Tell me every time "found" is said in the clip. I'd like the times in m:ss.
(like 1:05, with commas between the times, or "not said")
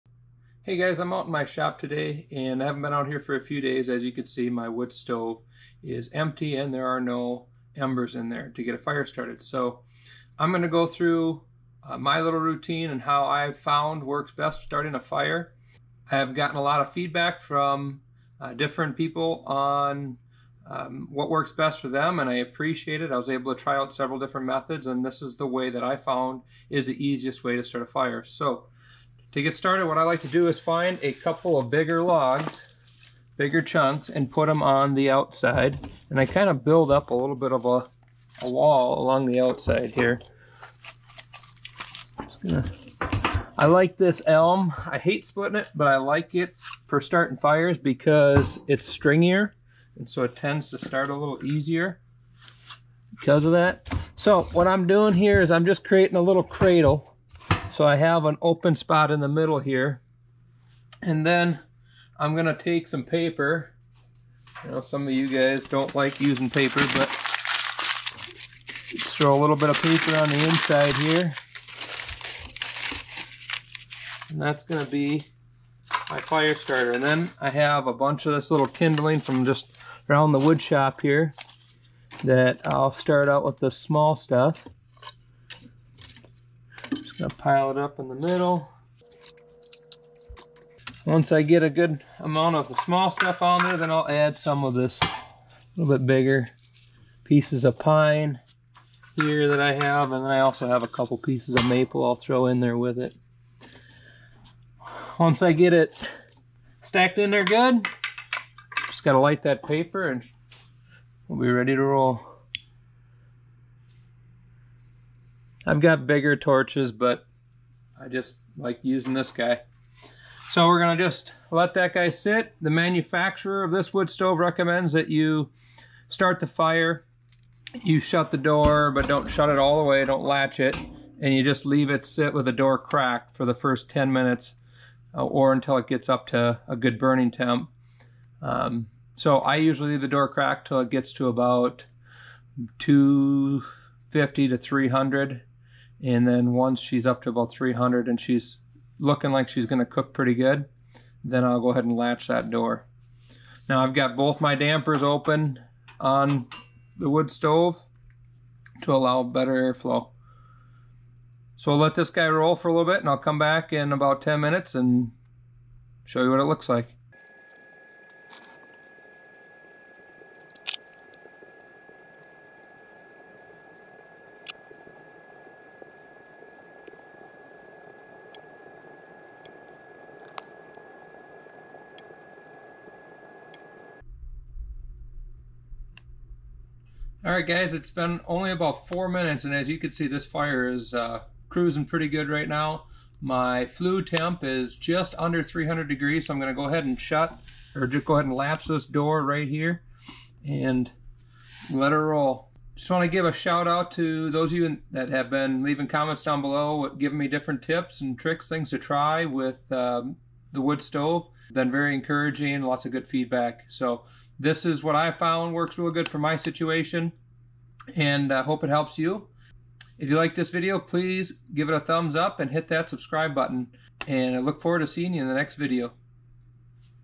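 0:13, 0:25, 3:35.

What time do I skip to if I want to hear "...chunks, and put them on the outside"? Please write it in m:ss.
0:33.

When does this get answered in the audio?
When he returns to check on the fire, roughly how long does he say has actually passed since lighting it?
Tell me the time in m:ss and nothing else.
3:08.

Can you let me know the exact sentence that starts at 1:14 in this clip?
And that's gonna be my fire starter.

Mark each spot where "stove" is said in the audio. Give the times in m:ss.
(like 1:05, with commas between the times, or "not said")
0:04, 2:04, 2:37, 3:30.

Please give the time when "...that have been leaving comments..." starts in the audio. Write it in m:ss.
3:24.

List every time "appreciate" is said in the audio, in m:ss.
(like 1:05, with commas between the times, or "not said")
0:22.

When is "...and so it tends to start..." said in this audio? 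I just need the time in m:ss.
0:49.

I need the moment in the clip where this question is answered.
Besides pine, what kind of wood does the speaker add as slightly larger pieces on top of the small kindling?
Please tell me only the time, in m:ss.
1:41.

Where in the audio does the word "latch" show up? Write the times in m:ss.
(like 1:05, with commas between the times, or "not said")
2:10, 2:31.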